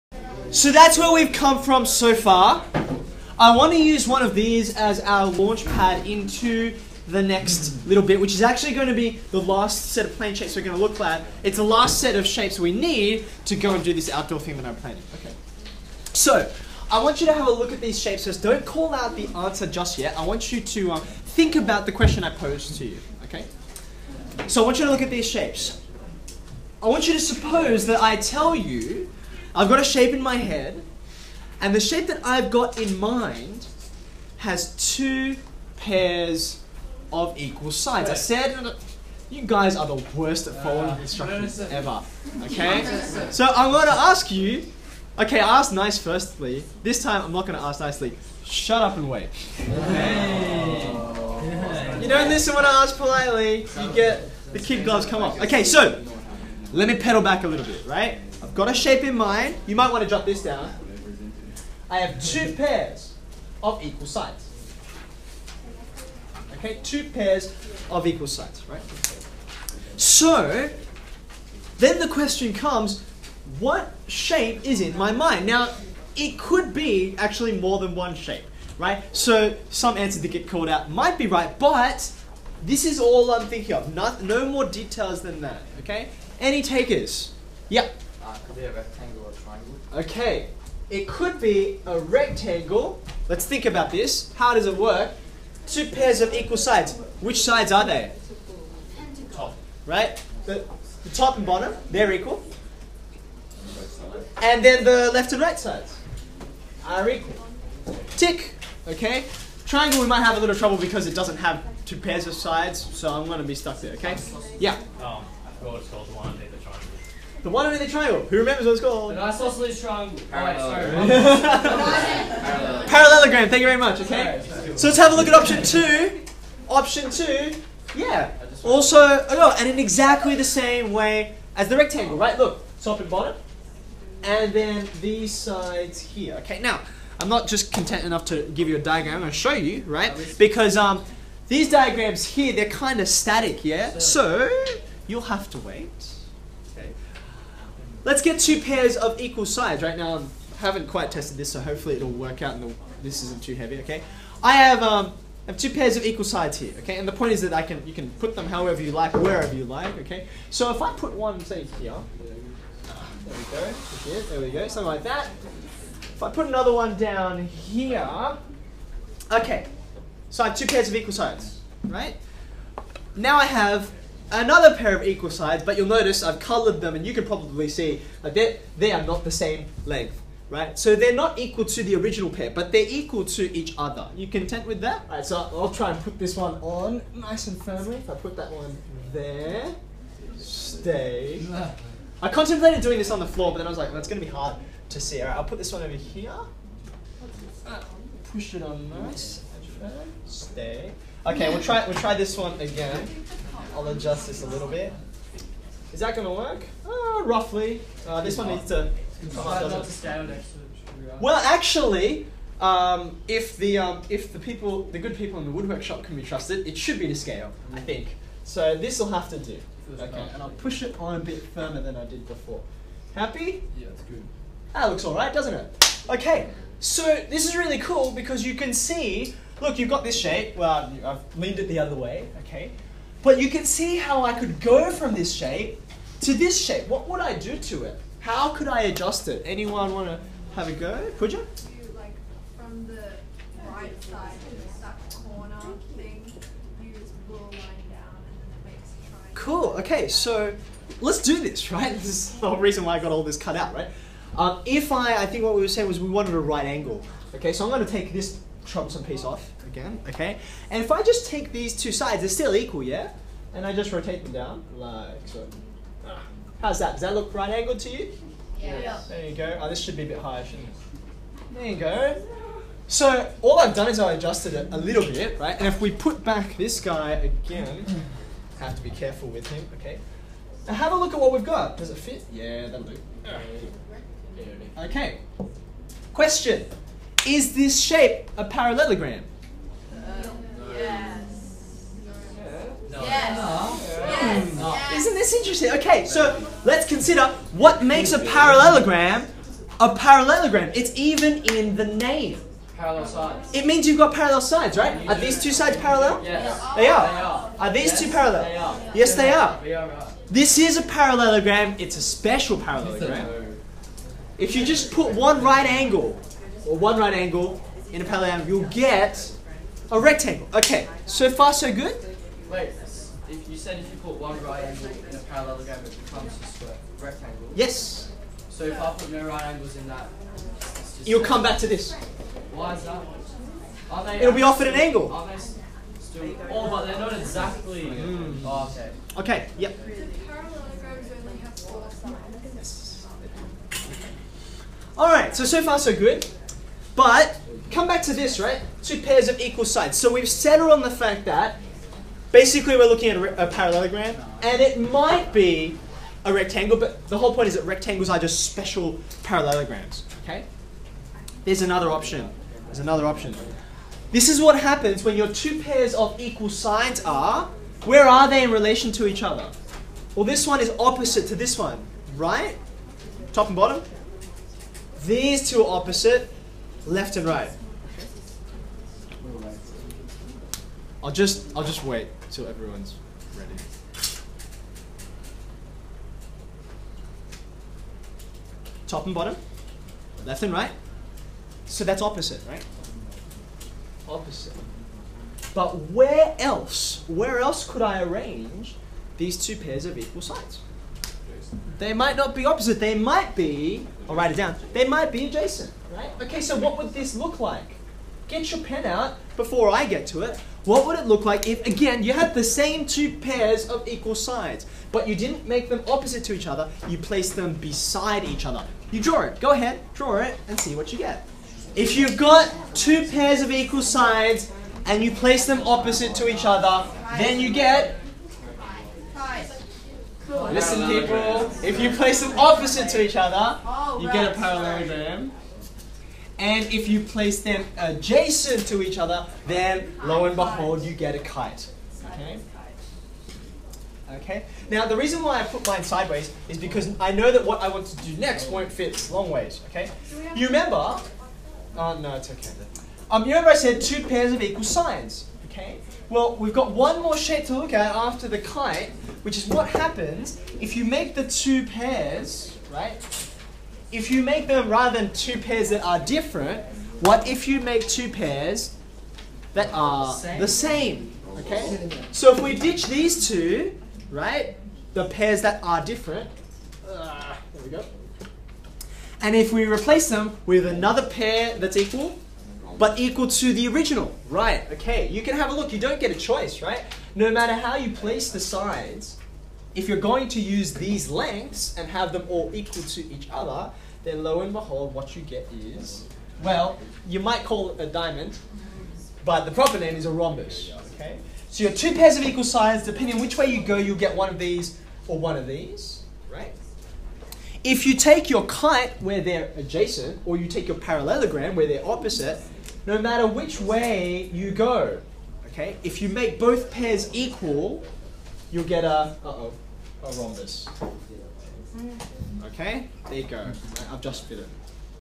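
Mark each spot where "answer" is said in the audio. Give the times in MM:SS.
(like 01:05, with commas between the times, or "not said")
00:19, 01:19.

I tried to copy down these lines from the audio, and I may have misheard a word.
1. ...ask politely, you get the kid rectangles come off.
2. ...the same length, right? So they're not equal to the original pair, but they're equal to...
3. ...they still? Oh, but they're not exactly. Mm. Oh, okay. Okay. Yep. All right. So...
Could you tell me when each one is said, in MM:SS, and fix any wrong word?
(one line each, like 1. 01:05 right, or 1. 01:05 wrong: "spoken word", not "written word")
1. 00:52 wrong: "gloves", not "rectangles"
2. 02:59 right
3. 05:35 right.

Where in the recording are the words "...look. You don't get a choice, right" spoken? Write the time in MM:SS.
08:05.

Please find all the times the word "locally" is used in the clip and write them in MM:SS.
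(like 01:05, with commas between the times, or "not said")
not said.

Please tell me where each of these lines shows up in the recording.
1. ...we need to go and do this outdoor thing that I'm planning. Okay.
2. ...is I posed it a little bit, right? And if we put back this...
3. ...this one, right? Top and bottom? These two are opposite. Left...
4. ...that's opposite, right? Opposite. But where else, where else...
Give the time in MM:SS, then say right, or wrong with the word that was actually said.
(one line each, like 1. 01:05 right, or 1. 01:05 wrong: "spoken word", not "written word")
1. 00:12 right
2. 04:33 wrong: "adjusted", not "posed"
3. 06:11 right
4. 06:31 right.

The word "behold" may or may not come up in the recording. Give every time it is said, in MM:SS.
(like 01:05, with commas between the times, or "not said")
07:20, 08:14.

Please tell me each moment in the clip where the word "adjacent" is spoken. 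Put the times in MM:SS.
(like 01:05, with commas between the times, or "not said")
06:45, 07:17, 08:29.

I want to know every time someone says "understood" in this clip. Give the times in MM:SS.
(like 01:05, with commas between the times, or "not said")
not said.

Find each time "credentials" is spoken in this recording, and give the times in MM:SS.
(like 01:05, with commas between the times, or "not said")
not said.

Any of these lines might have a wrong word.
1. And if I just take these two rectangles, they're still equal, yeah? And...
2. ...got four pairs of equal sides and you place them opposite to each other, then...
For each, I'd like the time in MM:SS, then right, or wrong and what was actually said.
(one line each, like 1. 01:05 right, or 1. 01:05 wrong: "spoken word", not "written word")
1. 04:20 wrong: "sides", not "rectangles"
2. 07:02 wrong: "two", not "four".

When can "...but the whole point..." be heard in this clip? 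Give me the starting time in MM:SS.
05:56.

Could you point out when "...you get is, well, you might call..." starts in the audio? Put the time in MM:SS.
08:15.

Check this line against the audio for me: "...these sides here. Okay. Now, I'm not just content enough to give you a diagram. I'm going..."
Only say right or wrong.
right.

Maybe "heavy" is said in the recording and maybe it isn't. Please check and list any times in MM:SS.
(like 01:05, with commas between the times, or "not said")
02:33.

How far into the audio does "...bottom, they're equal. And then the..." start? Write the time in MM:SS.
01:41.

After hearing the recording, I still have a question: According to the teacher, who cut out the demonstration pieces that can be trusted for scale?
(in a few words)
Woodwork shop.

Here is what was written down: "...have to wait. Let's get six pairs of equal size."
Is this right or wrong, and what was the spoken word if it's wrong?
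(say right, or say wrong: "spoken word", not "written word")
wrong: "two", not "six".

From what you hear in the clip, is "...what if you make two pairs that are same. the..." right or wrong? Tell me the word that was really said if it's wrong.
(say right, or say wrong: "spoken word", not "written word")
right.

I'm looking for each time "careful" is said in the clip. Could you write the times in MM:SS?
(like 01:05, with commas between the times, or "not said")
04:38.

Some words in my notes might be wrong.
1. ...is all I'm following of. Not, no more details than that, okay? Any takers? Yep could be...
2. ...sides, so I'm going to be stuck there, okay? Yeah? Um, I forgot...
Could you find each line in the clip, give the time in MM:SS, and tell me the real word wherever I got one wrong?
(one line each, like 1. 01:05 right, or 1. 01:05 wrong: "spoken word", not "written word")
1. 01:22 wrong: "thinking", not "following"
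2. 01:52 right.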